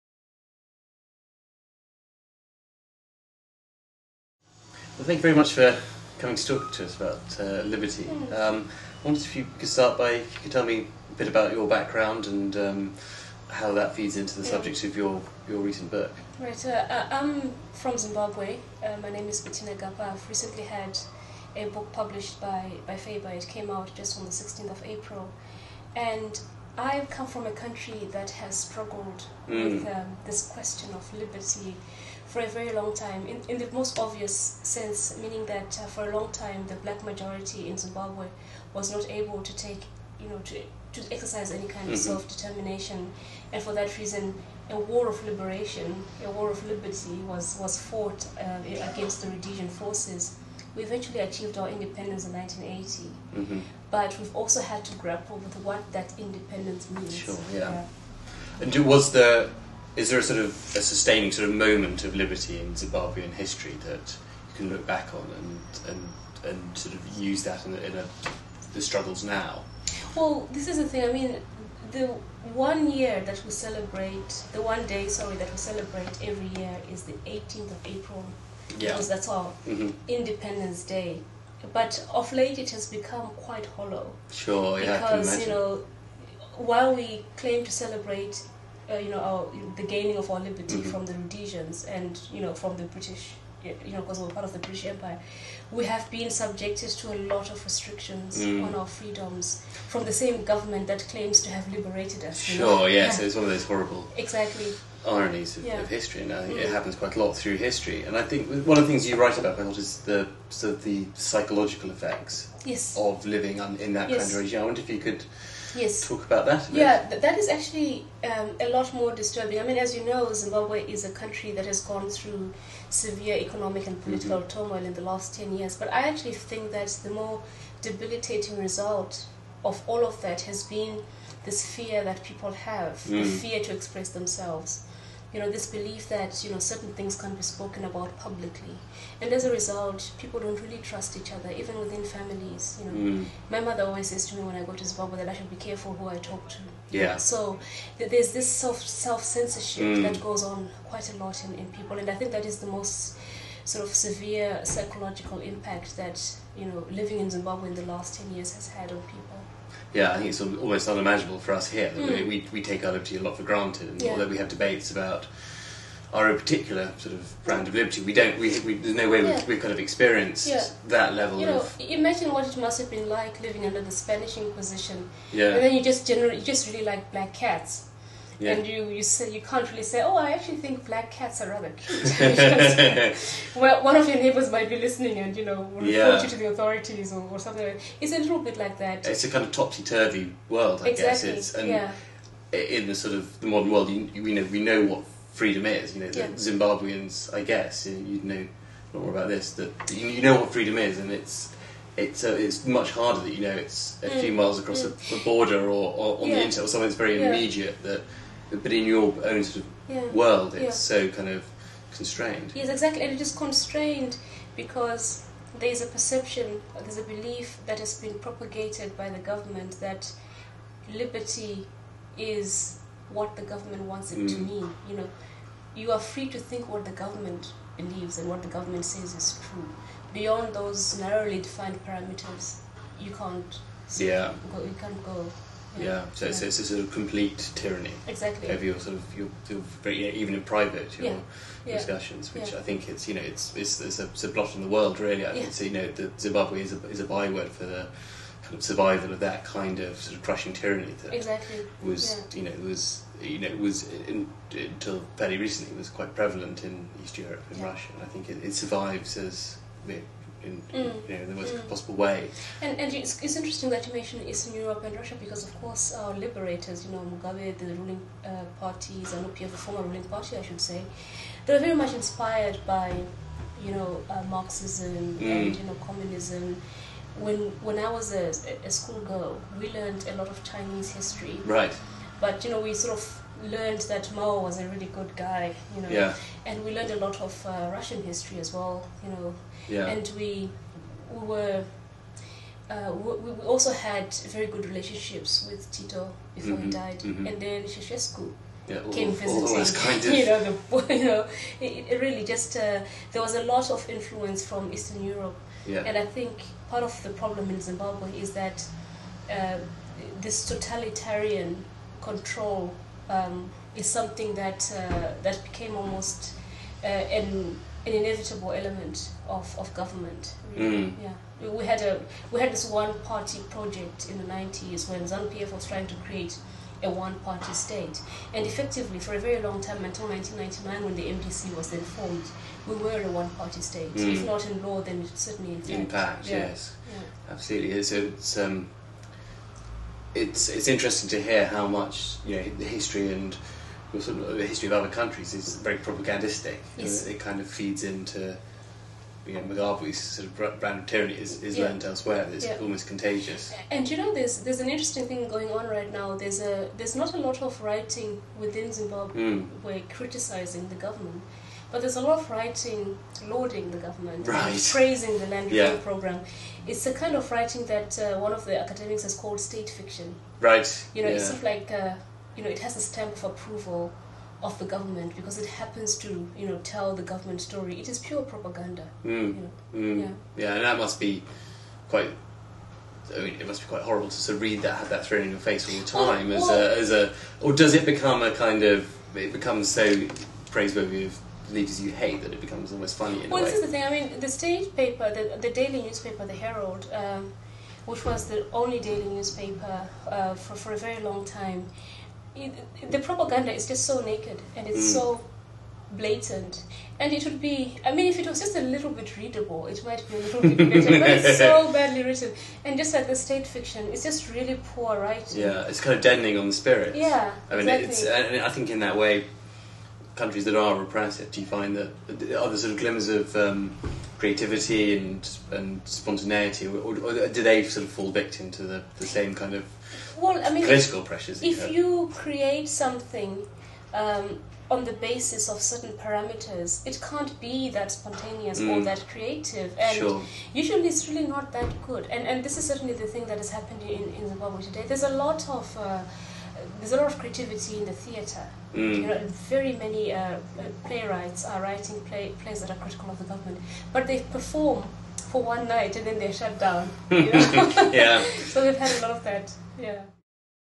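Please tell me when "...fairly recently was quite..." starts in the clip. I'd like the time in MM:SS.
04:15.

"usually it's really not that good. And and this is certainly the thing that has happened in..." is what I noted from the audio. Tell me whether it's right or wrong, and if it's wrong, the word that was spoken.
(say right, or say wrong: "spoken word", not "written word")
right.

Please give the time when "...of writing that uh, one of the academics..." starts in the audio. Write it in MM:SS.
06:07.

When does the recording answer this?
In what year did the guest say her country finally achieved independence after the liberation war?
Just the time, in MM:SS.
00:52.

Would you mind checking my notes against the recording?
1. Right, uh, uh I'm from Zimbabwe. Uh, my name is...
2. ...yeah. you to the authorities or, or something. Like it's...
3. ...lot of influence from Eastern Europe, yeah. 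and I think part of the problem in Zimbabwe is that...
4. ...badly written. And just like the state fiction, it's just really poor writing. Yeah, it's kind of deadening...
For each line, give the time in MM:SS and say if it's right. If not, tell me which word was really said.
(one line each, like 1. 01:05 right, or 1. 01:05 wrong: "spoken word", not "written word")
1. 00:16 right
2. 03:05 right
3. 05:03 right
4. 06:51 right.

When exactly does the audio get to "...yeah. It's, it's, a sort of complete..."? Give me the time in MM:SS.
03:56.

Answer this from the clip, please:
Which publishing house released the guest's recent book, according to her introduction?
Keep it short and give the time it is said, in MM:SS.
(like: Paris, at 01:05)
Faber, at 00:22.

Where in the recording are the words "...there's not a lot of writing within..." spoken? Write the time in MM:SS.
05:56.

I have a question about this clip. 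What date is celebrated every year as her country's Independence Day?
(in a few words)
18th of April.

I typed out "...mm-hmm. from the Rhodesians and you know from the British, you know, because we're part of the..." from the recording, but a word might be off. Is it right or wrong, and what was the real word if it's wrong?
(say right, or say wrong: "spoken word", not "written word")
right.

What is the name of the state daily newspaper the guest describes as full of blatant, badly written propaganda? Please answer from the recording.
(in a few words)
The Herald.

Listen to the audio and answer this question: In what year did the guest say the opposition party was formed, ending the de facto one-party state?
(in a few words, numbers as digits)
1999.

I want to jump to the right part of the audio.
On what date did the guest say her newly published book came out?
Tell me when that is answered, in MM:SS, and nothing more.
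00:24.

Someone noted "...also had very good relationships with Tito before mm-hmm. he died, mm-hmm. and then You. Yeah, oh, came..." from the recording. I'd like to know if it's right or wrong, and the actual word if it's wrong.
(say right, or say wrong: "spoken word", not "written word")
wrong: "Ceausescu", not "You".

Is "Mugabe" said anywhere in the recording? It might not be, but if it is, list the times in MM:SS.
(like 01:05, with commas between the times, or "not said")
04:26, 05:49.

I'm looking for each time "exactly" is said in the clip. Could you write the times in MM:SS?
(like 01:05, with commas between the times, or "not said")
01:44, 03:10, 03:32, 03:58, 04:11, 06:57.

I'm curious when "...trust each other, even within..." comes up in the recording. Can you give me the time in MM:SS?
02:20.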